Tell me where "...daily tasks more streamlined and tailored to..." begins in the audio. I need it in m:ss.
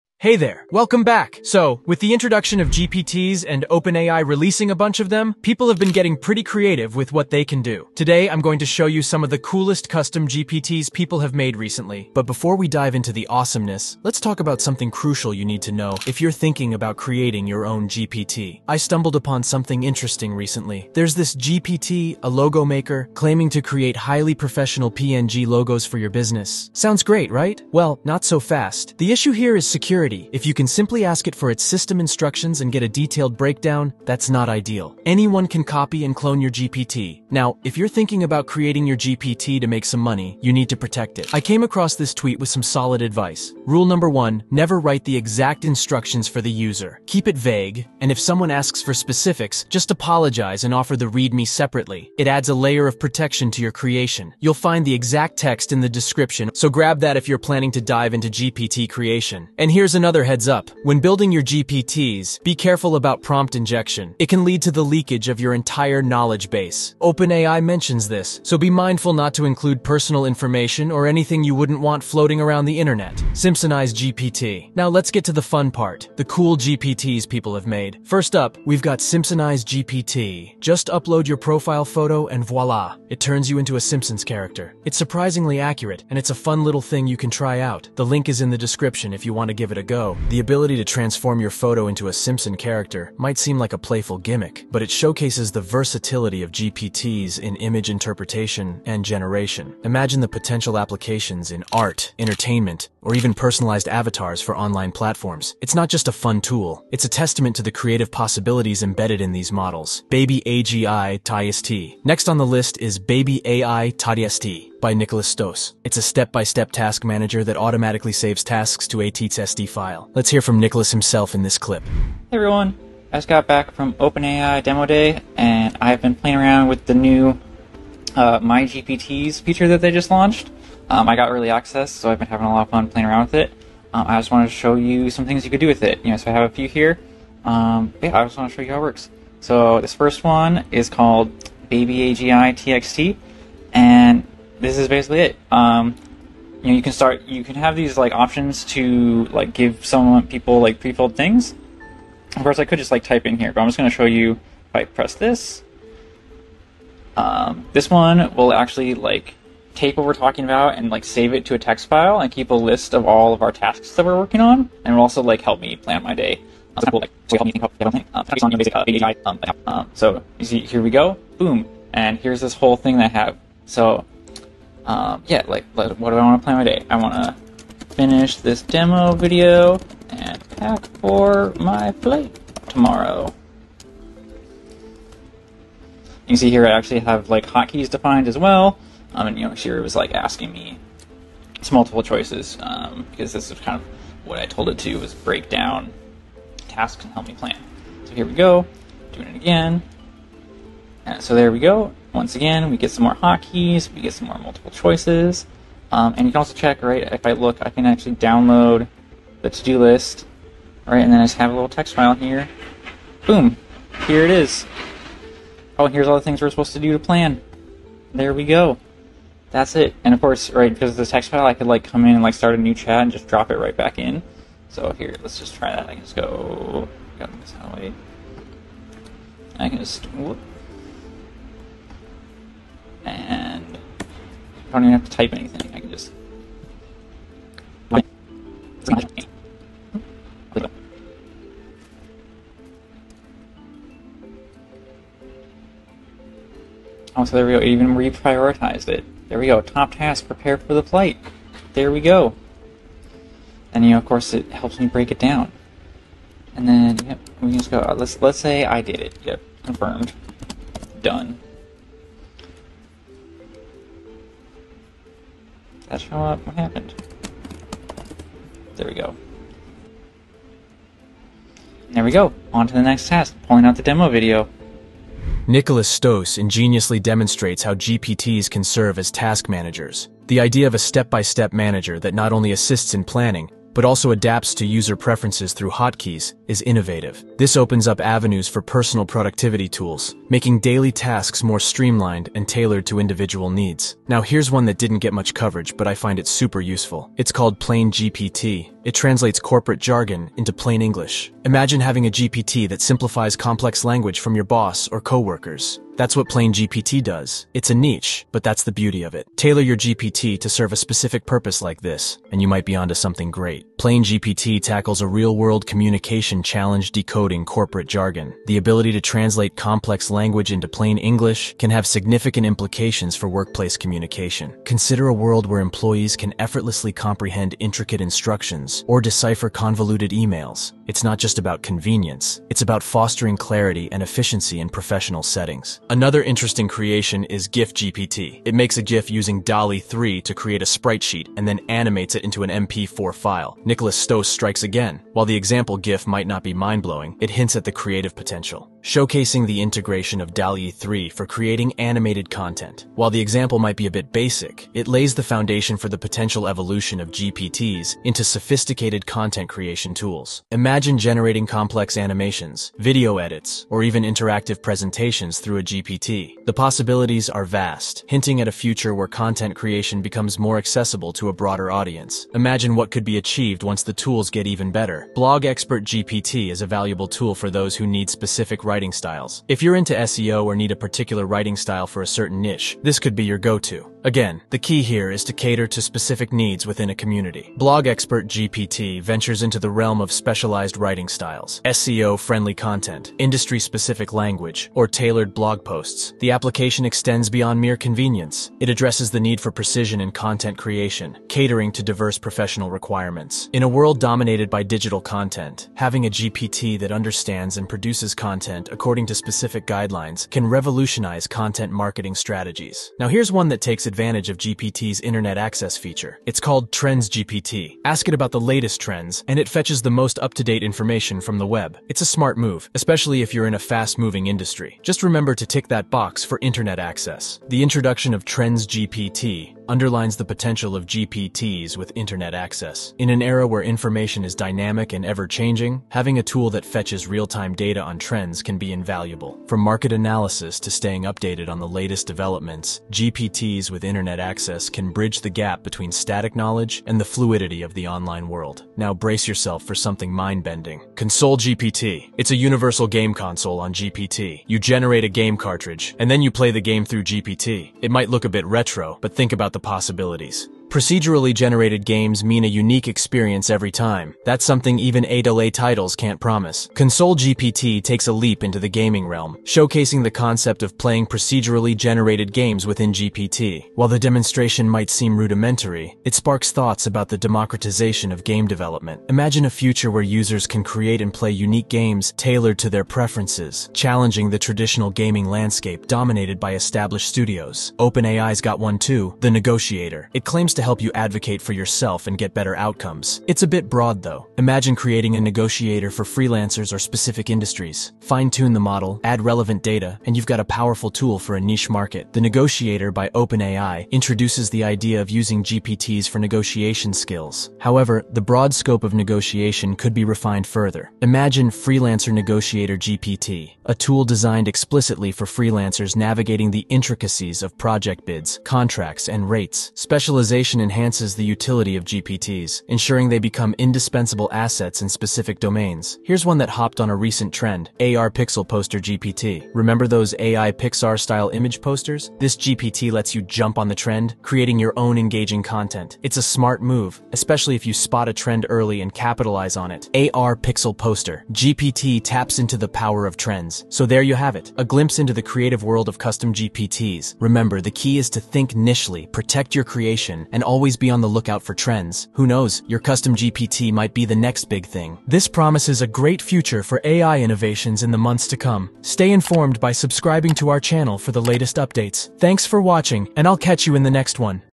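4:50.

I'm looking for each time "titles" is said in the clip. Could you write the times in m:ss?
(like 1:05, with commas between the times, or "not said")
7:45.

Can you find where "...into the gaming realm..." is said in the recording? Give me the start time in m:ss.
7:48.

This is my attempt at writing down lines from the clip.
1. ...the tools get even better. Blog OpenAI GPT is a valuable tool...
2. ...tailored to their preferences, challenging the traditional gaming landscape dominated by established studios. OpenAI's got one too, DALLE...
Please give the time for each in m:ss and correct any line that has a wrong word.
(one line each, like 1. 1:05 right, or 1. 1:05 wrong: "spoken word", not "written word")
1. 6:13 wrong: "Expert", not "OpenAI"
2. 8:02 wrong: "The", not "DALLE".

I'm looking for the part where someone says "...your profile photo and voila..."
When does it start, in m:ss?
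1:21.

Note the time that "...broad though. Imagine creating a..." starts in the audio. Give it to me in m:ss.
8:13.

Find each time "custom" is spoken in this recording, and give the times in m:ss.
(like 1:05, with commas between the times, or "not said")
0:09, 9:05, 9:12.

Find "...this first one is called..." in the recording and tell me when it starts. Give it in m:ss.
2:19.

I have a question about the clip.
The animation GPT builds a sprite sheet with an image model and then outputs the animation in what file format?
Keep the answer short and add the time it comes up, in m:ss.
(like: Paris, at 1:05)
MP4, at 5:42.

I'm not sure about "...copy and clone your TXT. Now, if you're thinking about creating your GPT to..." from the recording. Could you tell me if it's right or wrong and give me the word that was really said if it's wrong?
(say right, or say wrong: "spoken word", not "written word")
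wrong: "GPT", not "TXT".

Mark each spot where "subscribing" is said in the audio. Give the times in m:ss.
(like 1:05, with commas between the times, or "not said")
9:19.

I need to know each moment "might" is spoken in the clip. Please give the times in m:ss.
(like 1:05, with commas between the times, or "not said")
1:33, 5:12, 5:46, 5:53, 7:37, 7:54, 9:13.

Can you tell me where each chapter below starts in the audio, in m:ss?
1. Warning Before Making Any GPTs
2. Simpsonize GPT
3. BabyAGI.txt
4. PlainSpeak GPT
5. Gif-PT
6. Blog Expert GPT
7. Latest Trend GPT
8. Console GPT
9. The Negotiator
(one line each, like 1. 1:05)
1. 0:12
2. 1:13
3. 1:50
4. 4:54
5. 5:35
6. 6:15
7. 6:53
8. 7:28
9. 8:07.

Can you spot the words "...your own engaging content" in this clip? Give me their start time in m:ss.
8:54.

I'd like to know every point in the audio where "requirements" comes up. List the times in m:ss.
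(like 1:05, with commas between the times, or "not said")
6:42.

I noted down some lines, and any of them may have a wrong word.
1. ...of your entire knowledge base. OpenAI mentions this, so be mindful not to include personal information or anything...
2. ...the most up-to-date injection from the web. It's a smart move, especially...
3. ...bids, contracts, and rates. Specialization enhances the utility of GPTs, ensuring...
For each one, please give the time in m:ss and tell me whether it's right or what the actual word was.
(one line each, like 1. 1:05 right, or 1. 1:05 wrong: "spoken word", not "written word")
1. 1:05 right
2. 6:59 wrong: "information", not "injection"
3. 8:38 right.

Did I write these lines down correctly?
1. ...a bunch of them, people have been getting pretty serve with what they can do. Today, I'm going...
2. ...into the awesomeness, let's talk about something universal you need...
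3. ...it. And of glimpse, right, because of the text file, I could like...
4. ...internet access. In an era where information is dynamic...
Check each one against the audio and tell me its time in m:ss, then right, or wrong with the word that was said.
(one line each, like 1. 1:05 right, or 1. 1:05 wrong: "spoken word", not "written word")
1. 0:04 wrong: "creative", not "serve"
2. 0:12 wrong: "crucial", not "universal"
3. 3:39 wrong: "course", not "glimpse"
4. 7:11 right.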